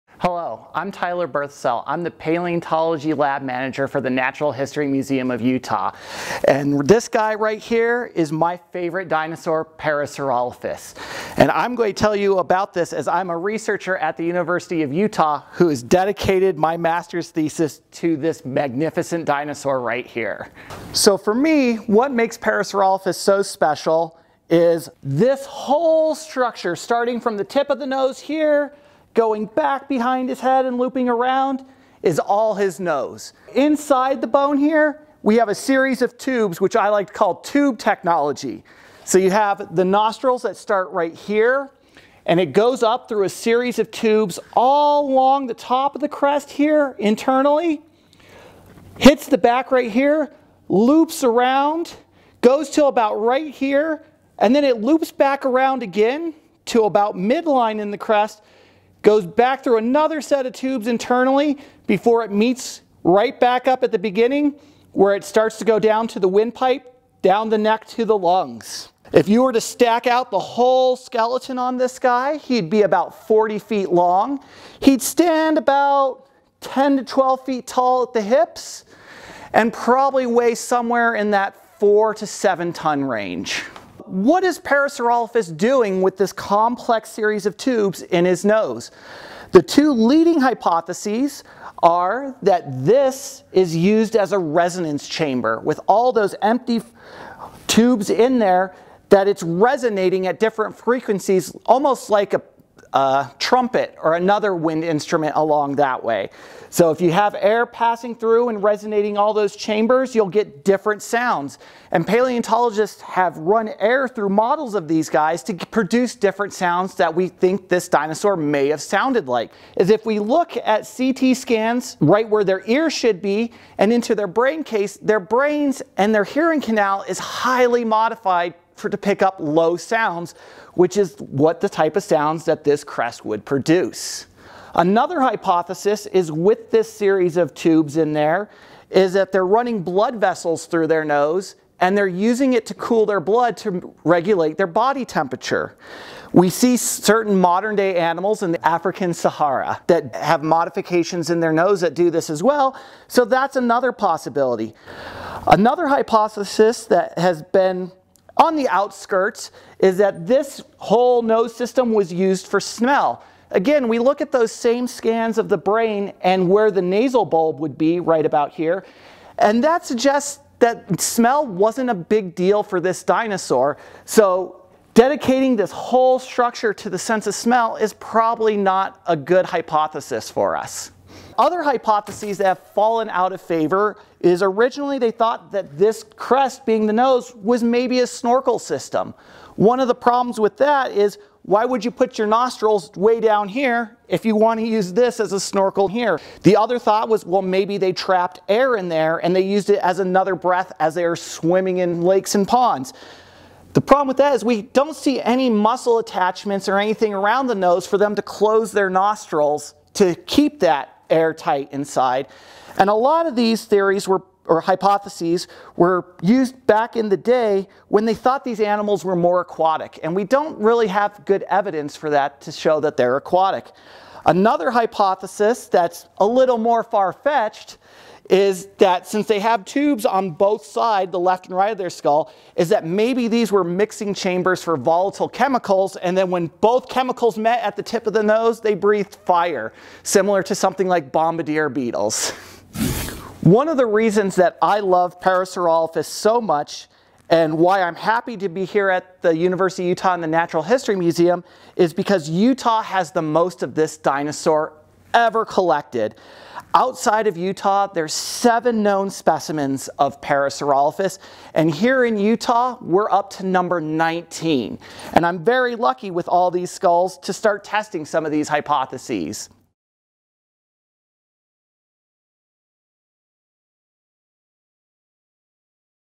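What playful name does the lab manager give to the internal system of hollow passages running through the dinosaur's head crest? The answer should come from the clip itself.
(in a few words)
tube technology.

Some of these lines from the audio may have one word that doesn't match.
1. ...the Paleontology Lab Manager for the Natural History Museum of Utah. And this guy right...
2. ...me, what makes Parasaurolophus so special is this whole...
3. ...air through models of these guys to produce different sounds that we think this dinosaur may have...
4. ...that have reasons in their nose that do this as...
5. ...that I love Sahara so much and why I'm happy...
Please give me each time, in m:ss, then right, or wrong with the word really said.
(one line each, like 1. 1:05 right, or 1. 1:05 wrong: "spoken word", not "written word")
1. 0:02 right
2. 0:21 right
3. 1:53 right
4. 2:29 wrong: "modifications", not "reasons"
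5. 4:04 wrong: "Parasaurolophus", not "Sahara".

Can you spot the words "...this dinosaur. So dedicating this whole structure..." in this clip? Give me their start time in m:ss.
2:52.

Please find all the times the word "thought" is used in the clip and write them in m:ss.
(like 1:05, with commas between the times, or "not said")
3:05, 3:16, 3:38.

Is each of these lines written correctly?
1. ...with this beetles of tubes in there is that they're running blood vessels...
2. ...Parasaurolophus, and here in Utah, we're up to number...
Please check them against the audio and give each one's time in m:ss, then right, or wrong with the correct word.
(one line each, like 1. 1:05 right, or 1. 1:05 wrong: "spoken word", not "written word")
1. 2:16 wrong: "series", not "beetles"
2. 4:20 right.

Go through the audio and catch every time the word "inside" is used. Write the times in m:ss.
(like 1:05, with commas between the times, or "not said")
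0:33, 3:31.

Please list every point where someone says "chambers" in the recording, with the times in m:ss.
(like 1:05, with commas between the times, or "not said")
1:35, 1:49, 3:54.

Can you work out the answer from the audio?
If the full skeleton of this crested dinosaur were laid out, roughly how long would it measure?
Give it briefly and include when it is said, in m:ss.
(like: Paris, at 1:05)
40 feet, at 1:13.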